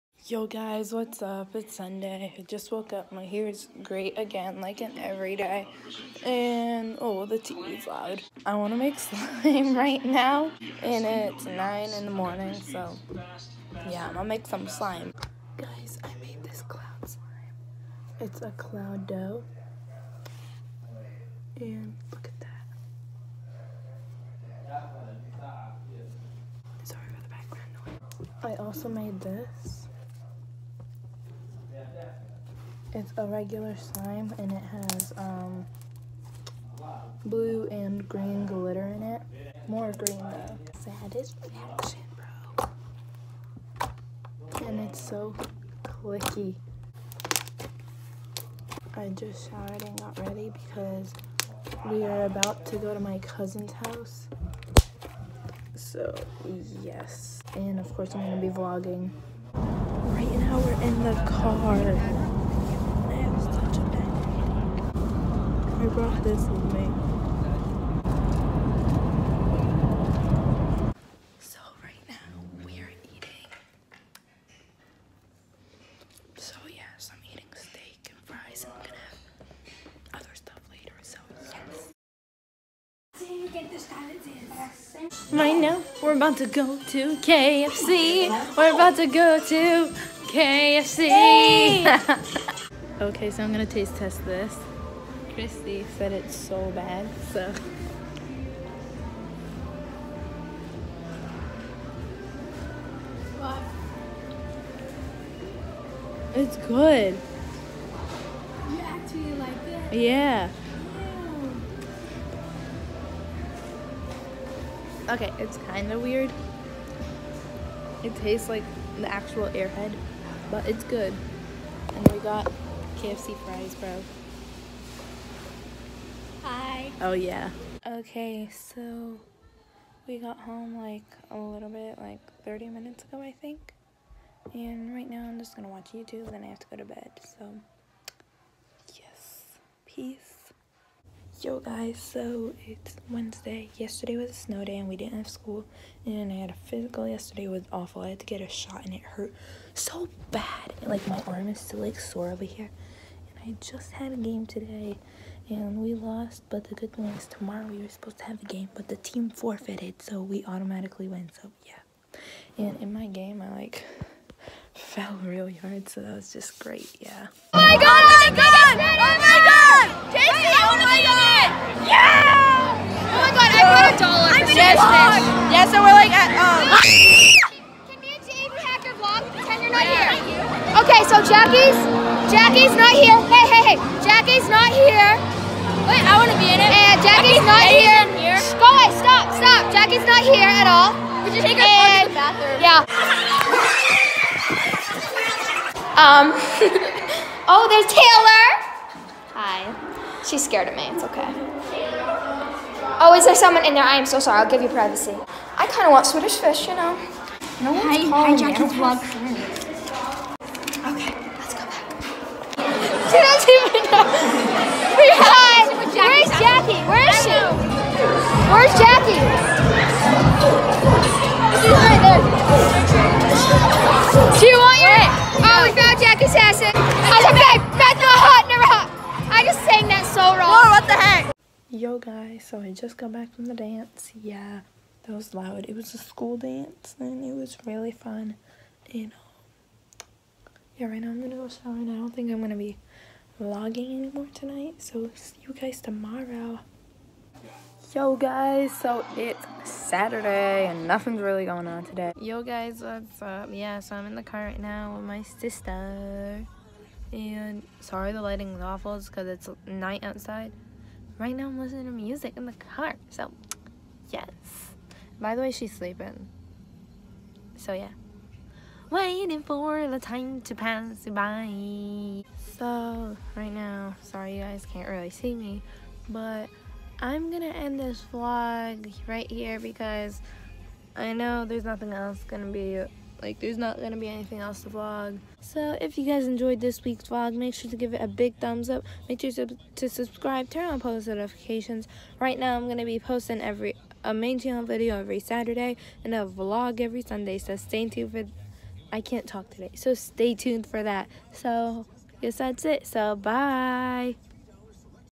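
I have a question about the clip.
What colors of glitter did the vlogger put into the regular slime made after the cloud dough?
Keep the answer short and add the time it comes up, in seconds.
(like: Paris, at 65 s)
Blue and green, at 37 s.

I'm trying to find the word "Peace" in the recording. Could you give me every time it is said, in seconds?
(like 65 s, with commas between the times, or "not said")
139 s.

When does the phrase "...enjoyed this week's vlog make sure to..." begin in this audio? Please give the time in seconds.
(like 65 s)
286 s.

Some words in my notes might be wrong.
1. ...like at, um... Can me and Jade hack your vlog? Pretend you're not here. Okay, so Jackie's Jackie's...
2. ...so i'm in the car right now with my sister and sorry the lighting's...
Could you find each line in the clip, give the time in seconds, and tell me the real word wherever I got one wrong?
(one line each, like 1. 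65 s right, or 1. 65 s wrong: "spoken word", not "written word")
1. 175 s right
2. 253 s right.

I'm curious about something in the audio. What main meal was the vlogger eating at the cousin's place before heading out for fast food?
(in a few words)
Steak and fries.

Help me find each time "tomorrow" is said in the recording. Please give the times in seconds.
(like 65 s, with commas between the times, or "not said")
157 s, 245 s.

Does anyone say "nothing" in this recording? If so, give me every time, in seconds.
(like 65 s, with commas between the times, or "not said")
250 s, 281 s.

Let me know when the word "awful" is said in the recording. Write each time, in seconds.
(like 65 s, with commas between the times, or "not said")
147 s, 258 s.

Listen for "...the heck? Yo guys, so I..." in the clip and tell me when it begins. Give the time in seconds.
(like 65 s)
230 s.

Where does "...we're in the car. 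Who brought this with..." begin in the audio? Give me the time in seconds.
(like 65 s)
60 s.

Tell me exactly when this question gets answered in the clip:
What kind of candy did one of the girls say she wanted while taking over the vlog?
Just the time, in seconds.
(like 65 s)
206 s.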